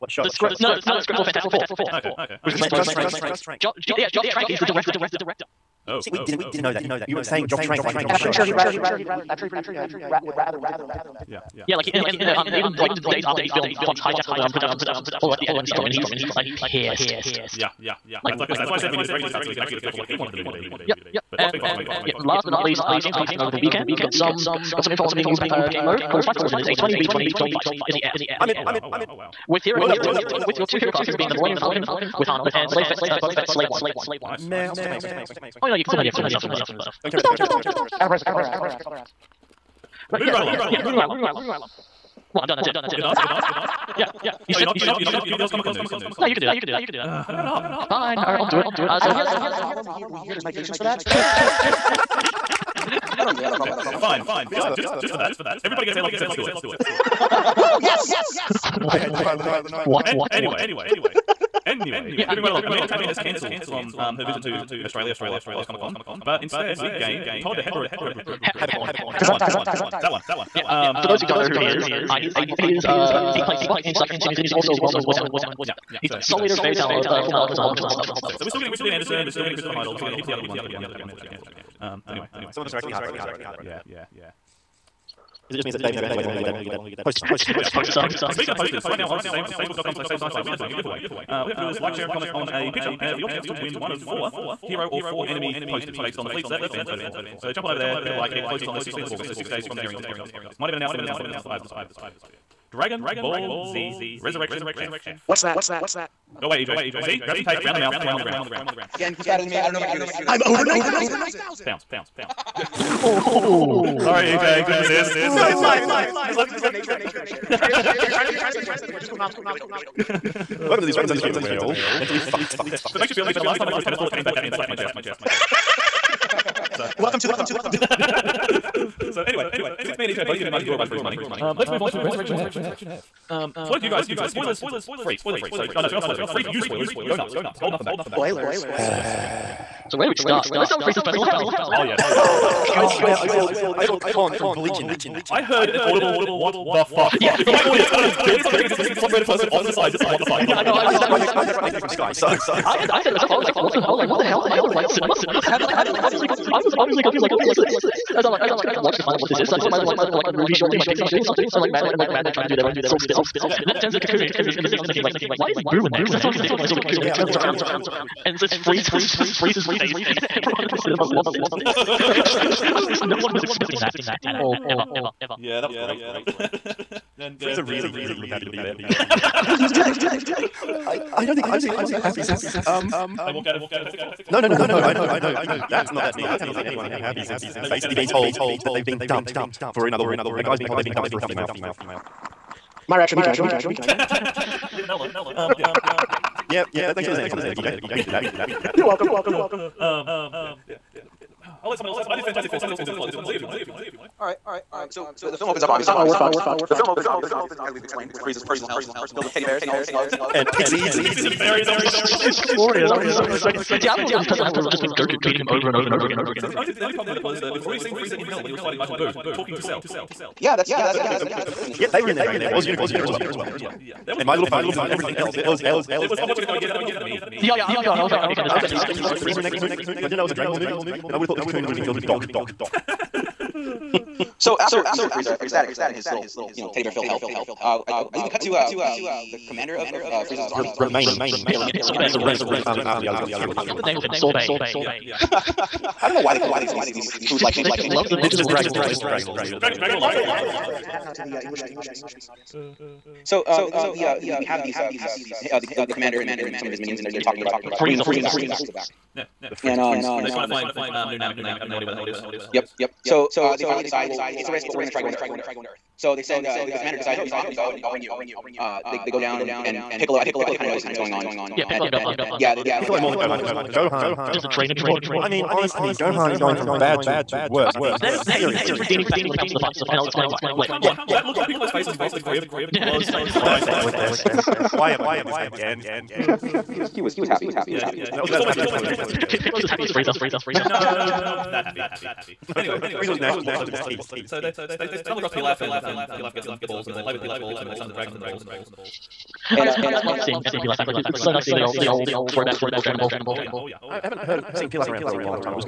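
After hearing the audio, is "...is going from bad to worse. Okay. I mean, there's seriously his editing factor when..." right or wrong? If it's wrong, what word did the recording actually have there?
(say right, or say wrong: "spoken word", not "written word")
wrong: "redeeming", not "editing".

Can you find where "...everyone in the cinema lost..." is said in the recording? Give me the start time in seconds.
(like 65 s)
170 s.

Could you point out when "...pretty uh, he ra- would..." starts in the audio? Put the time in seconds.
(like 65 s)
9 s.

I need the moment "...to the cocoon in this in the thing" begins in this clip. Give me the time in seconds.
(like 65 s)
163 s.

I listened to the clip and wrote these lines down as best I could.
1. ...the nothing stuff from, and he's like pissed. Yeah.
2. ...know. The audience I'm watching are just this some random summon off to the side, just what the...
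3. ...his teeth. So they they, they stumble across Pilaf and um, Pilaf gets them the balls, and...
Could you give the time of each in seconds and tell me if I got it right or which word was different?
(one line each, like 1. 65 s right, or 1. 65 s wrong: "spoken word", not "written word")
1. 15 s wrong: "editing", not "nothing"
2. 148 s wrong: "person", not "summon"
3. 293 s right.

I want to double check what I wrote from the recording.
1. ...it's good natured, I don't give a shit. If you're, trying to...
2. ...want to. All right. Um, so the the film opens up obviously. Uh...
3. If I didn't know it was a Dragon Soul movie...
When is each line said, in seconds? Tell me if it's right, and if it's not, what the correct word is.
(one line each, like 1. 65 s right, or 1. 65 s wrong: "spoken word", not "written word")
1. 116 s right
2. 203 s right
3. 230 s wrong: "Ball", not "Soul".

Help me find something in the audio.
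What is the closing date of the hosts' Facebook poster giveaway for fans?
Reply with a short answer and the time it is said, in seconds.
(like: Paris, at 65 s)
16th of August, at 98 s.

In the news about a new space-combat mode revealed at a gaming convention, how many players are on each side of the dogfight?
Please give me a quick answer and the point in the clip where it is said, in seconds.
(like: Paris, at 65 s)
20 v 20, at 26 s.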